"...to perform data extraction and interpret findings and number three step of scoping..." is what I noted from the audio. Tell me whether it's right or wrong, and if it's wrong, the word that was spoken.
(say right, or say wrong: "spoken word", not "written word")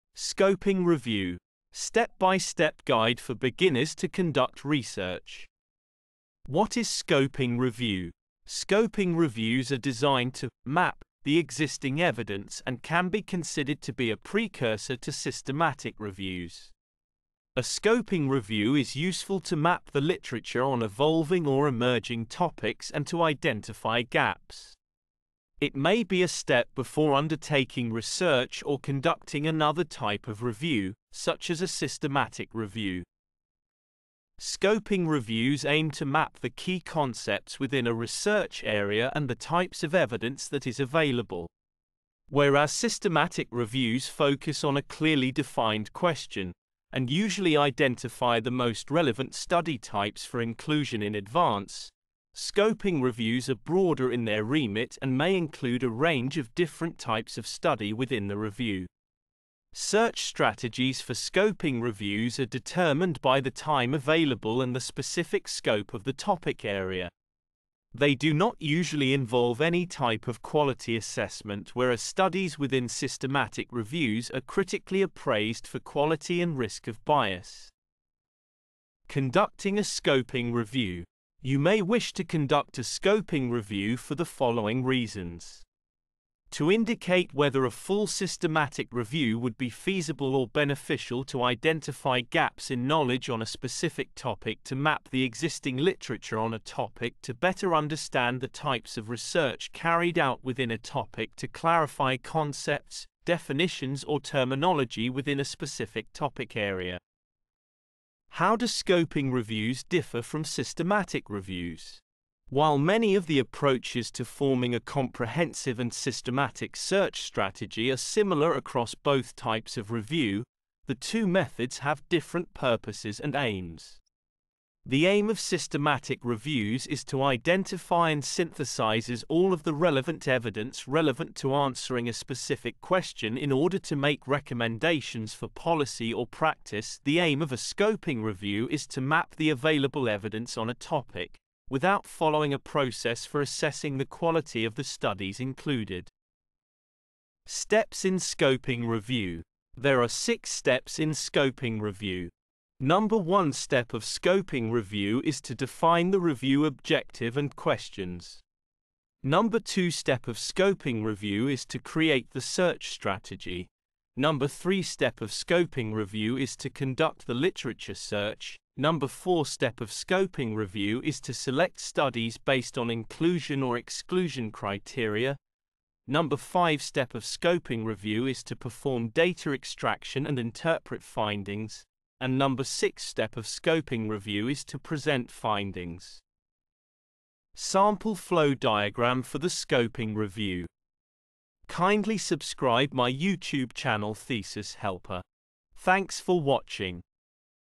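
wrong: "six", not "three".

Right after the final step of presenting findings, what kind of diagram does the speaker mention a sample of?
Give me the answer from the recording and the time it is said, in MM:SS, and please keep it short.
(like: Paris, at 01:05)
Flow diagram, at 03:08.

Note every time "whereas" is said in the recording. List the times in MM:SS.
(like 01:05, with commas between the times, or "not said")
00:42, 01:11.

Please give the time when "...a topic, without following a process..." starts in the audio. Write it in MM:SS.
02:20.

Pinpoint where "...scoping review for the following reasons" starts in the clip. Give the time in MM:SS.
01:22.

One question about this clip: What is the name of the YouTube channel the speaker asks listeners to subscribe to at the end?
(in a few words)
Thesis Helper.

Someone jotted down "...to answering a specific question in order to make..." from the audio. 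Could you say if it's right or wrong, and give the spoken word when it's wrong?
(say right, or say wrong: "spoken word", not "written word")
right.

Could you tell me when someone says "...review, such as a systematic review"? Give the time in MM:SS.
00:30.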